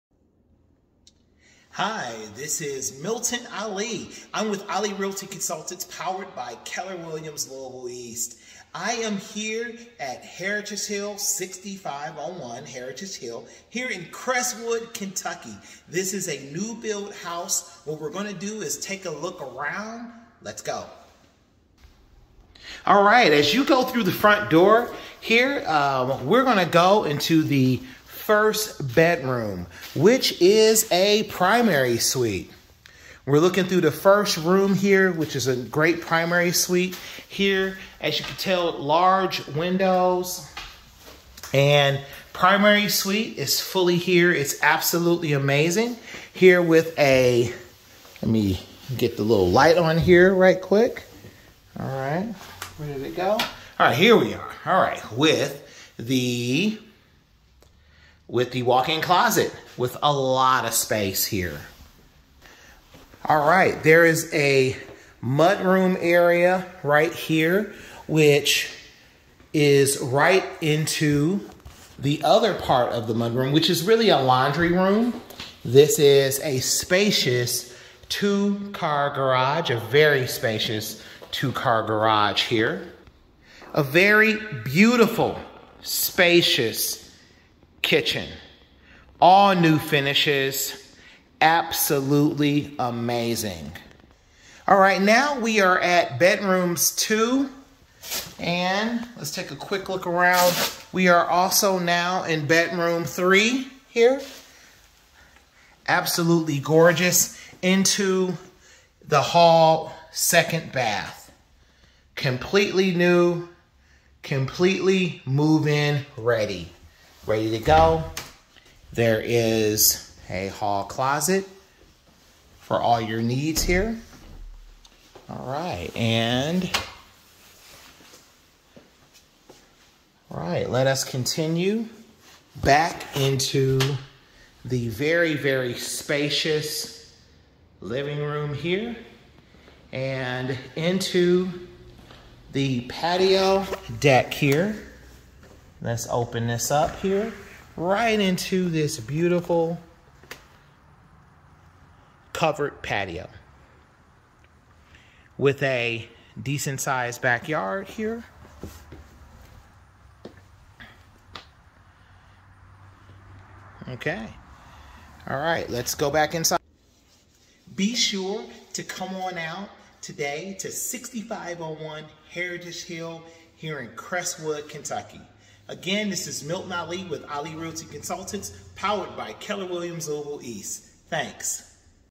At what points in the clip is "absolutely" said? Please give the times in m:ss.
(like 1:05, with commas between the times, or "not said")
0:44, 1:31, 1:45.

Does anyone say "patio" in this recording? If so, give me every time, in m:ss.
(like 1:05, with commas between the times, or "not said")
2:22, 2:32.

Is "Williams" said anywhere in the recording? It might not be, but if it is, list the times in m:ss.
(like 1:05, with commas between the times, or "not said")
0:06, 2:59.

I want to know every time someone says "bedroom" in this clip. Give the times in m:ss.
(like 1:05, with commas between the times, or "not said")
0:28, 1:36, 1:42.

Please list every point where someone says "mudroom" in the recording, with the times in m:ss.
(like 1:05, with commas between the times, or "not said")
1:05, 1:13.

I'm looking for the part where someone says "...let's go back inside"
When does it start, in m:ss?
2:45.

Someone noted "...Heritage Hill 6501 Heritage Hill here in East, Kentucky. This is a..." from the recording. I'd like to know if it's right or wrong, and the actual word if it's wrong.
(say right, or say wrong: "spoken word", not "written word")
wrong: "Crestwood", not "East".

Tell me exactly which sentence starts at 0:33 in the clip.
We're looking through the first room here, which is a great primary suite here.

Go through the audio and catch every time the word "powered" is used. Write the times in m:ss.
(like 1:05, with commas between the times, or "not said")
0:05, 2:58.